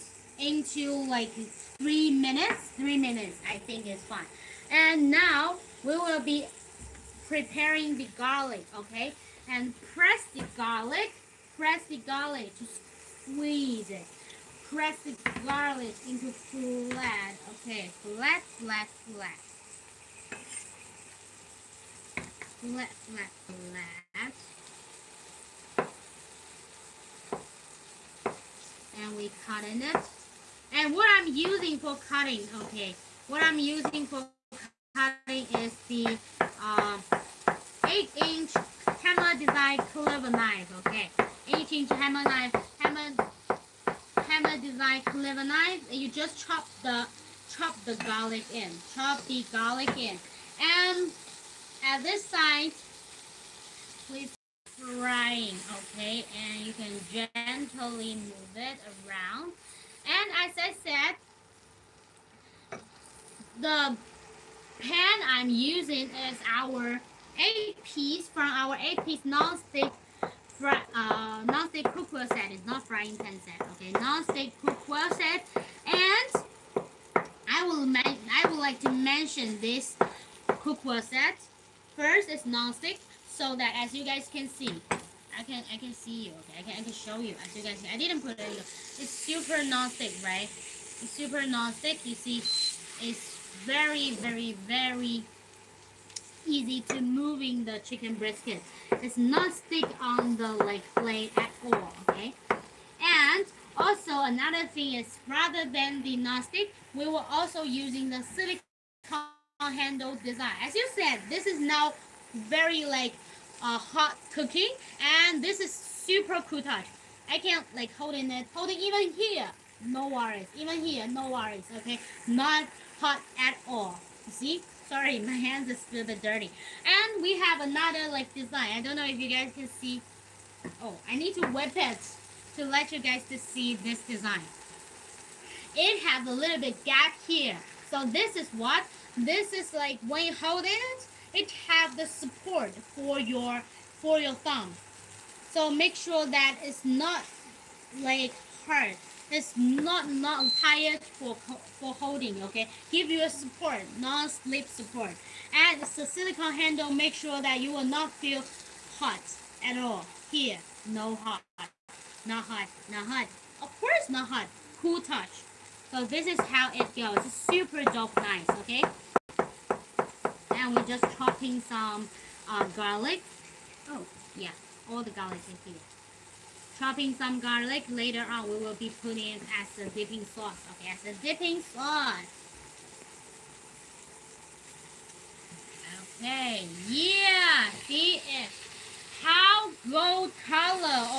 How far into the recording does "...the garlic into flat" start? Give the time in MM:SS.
00:14.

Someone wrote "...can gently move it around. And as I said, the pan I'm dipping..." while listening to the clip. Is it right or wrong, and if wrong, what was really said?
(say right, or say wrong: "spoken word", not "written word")
wrong: "using", not "dipping".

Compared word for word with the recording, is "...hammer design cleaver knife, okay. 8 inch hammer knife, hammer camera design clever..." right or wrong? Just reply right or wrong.
right.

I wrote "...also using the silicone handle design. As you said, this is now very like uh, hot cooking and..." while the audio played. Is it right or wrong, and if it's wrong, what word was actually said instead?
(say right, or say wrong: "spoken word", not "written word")
right.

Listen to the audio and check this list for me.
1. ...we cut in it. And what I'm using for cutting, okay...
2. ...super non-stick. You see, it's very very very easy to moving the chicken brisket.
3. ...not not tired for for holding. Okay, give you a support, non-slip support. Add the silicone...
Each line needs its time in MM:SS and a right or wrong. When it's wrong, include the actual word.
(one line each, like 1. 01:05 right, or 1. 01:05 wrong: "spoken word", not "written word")
1. 00:29 right
2. 01:31 right
3. 02:29 right.